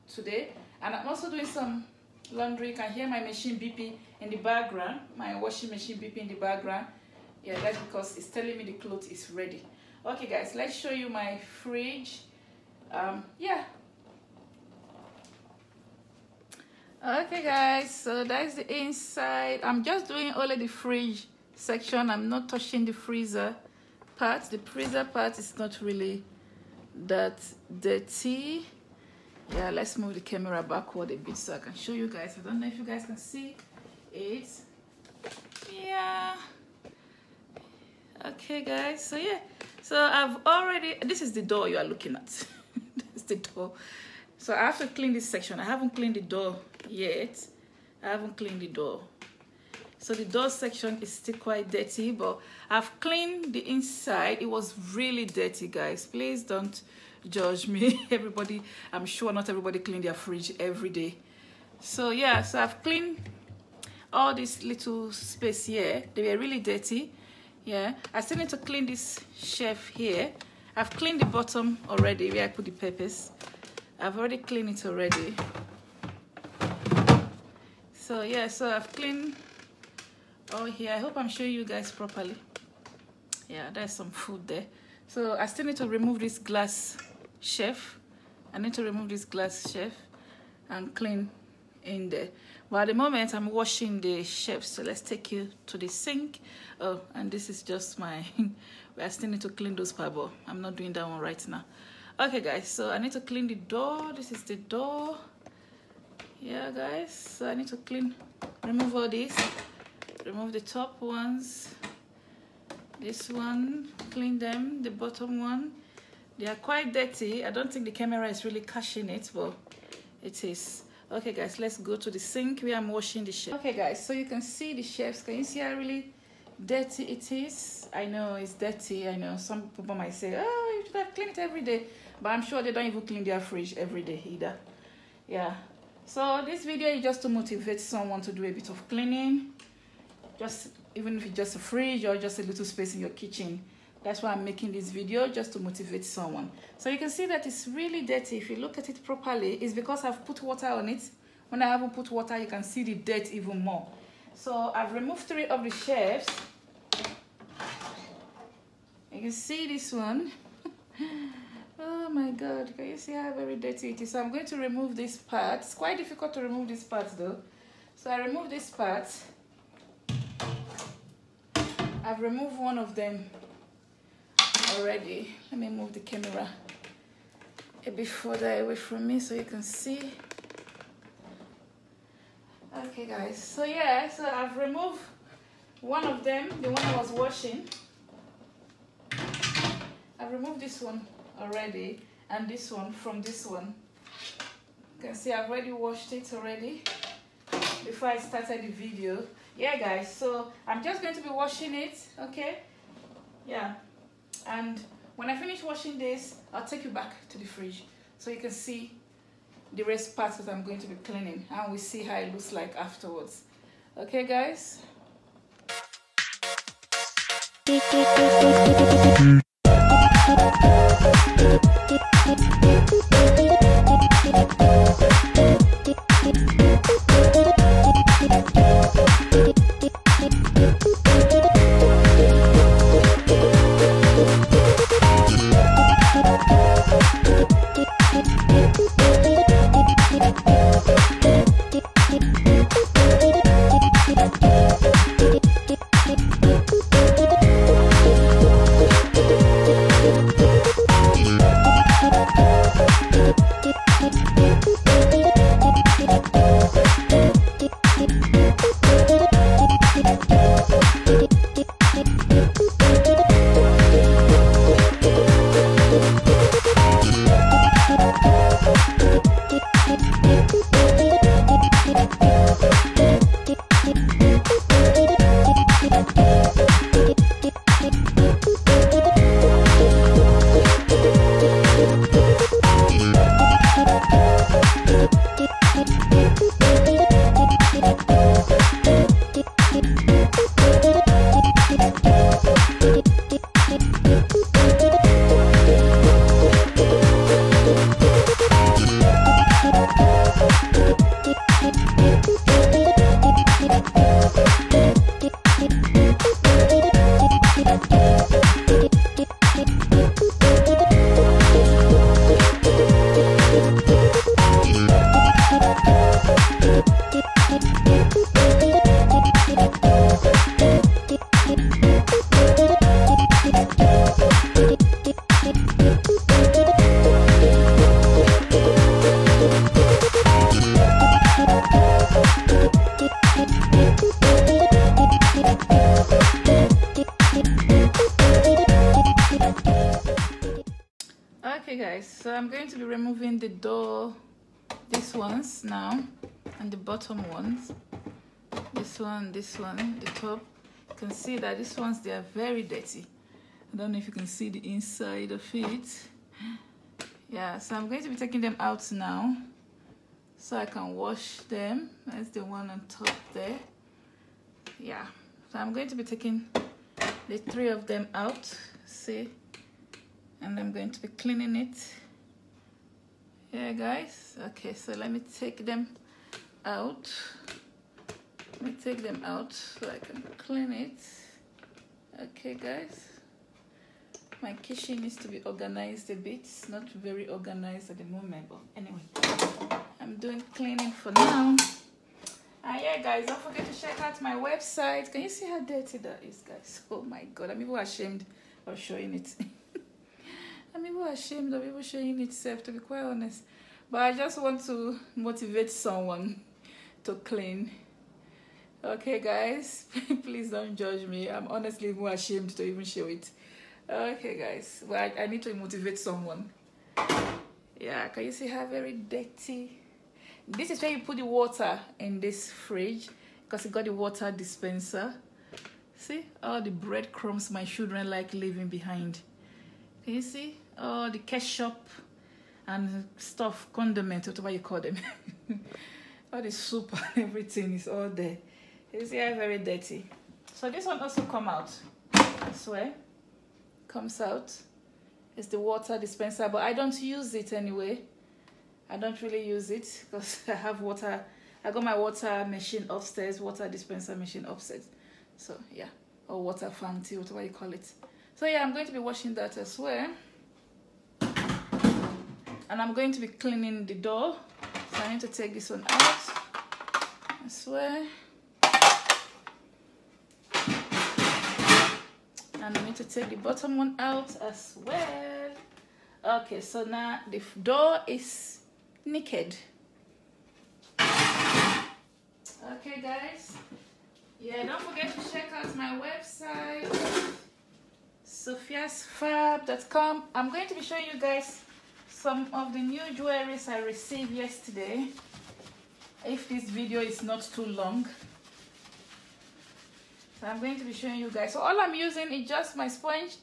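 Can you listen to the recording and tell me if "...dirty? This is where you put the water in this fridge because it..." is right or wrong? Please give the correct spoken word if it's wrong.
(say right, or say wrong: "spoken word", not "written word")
right.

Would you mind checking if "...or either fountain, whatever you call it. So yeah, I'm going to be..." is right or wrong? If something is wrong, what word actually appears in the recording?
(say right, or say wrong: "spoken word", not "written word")
wrong: "water", not "either".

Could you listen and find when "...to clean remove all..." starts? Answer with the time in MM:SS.
01:47.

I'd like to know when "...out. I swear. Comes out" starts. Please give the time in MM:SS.
07:21.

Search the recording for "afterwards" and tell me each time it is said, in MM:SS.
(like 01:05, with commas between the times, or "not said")
03:32.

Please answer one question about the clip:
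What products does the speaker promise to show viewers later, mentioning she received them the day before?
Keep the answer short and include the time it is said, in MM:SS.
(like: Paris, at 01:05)
jewelries, at 08:13.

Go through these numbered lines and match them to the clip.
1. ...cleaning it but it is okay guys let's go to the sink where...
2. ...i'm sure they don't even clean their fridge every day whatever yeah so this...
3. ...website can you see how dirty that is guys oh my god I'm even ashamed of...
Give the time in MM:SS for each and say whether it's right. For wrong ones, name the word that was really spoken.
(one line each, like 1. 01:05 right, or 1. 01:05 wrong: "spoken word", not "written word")
1. 01:58 wrong: "catching", not "cleaning"
2. 02:12 wrong: "either", not "whatever"
3. 06:34 right.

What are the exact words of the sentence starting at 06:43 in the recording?
But I just want to motivate someone to clean.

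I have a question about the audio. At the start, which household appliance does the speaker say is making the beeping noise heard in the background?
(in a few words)
washing machine.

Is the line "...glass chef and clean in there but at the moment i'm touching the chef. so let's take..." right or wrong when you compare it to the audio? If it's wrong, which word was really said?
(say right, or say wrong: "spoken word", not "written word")
wrong: "washing", not "touching".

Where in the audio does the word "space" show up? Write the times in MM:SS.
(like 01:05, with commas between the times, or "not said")
01:05, 02:22.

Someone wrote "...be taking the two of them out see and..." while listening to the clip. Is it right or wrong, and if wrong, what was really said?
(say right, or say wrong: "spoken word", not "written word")
wrong: "three", not "two".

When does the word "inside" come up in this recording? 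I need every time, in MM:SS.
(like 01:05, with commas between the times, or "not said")
00:18, 00:53, 05:54.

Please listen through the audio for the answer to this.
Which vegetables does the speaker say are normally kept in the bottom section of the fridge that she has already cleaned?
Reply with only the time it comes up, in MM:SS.
01:12.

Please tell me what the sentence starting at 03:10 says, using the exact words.
I've removed this one already and this one from this one.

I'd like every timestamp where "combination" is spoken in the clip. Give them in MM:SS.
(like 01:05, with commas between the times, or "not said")
not said.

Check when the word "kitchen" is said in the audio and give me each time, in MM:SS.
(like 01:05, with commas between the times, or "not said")
02:23, 06:24.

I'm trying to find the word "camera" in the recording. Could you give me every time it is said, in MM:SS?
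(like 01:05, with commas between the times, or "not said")
00:30, 01:57, 02:55.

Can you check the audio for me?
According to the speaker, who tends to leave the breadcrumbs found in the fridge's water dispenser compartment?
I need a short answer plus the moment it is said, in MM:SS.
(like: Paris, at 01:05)
my children, at 07:07.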